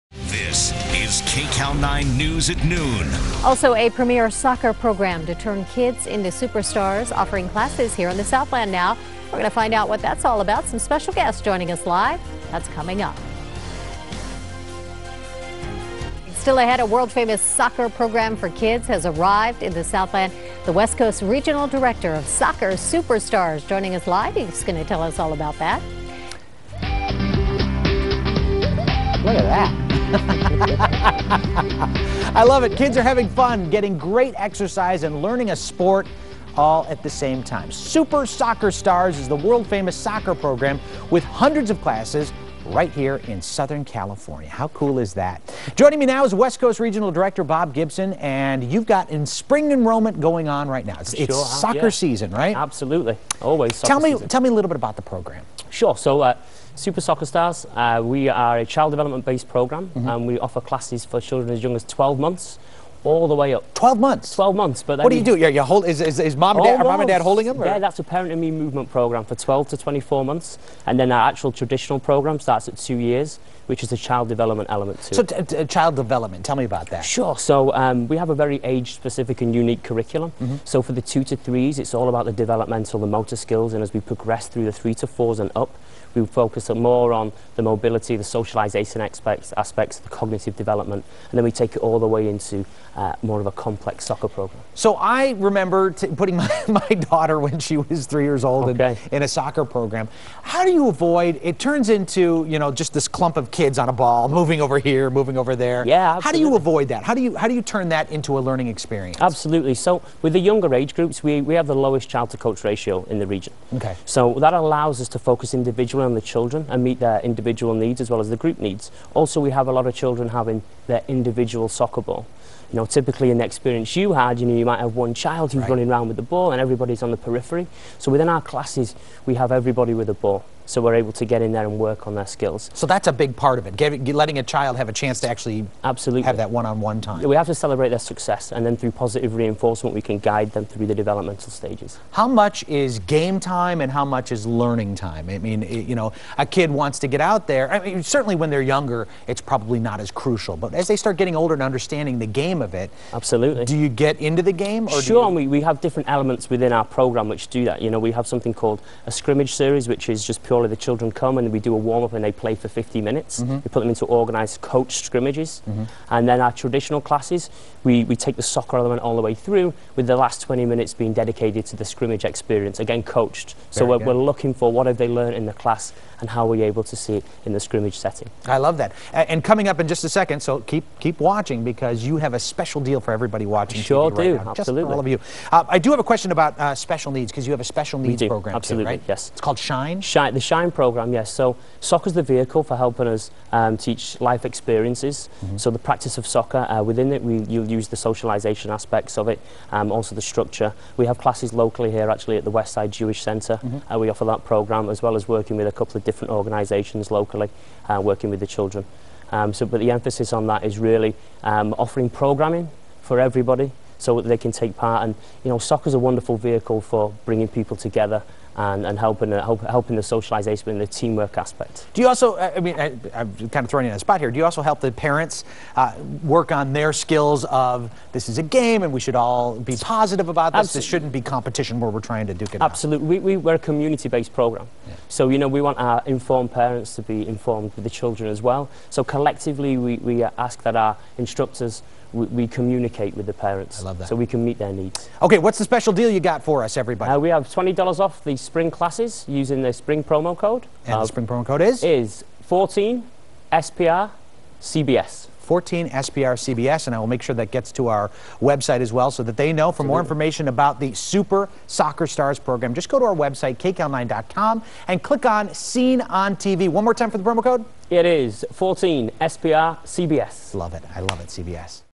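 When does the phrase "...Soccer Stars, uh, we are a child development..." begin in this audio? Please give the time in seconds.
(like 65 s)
57 s.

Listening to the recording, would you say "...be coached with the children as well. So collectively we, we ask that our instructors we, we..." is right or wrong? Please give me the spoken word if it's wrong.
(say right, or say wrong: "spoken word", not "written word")
wrong: "informed", not "coached".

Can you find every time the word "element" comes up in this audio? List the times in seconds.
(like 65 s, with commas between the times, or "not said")
74 s, 156 s, 168 s.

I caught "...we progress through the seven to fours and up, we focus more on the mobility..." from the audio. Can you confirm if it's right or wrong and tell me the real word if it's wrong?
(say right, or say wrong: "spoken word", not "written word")
wrong: "three", not "seven".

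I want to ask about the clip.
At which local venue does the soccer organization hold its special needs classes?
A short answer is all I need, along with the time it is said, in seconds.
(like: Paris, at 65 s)
Westside Jewish Centre, at 202 s.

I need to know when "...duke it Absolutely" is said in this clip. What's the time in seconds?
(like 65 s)
232 s.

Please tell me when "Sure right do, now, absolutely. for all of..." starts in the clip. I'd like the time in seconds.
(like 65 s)
183 s.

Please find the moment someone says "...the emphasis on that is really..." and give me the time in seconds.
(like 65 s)
209 s.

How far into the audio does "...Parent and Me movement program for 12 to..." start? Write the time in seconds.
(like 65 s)
68 s.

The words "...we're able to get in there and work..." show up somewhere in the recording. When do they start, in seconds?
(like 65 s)
130 s.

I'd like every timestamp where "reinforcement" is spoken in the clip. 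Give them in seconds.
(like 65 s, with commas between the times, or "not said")
139 s.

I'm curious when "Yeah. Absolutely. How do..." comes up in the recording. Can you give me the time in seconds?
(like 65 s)
105 s.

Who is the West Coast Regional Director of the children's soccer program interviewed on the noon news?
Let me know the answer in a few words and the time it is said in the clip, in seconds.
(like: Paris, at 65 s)
Bob Gibson, at 47 s.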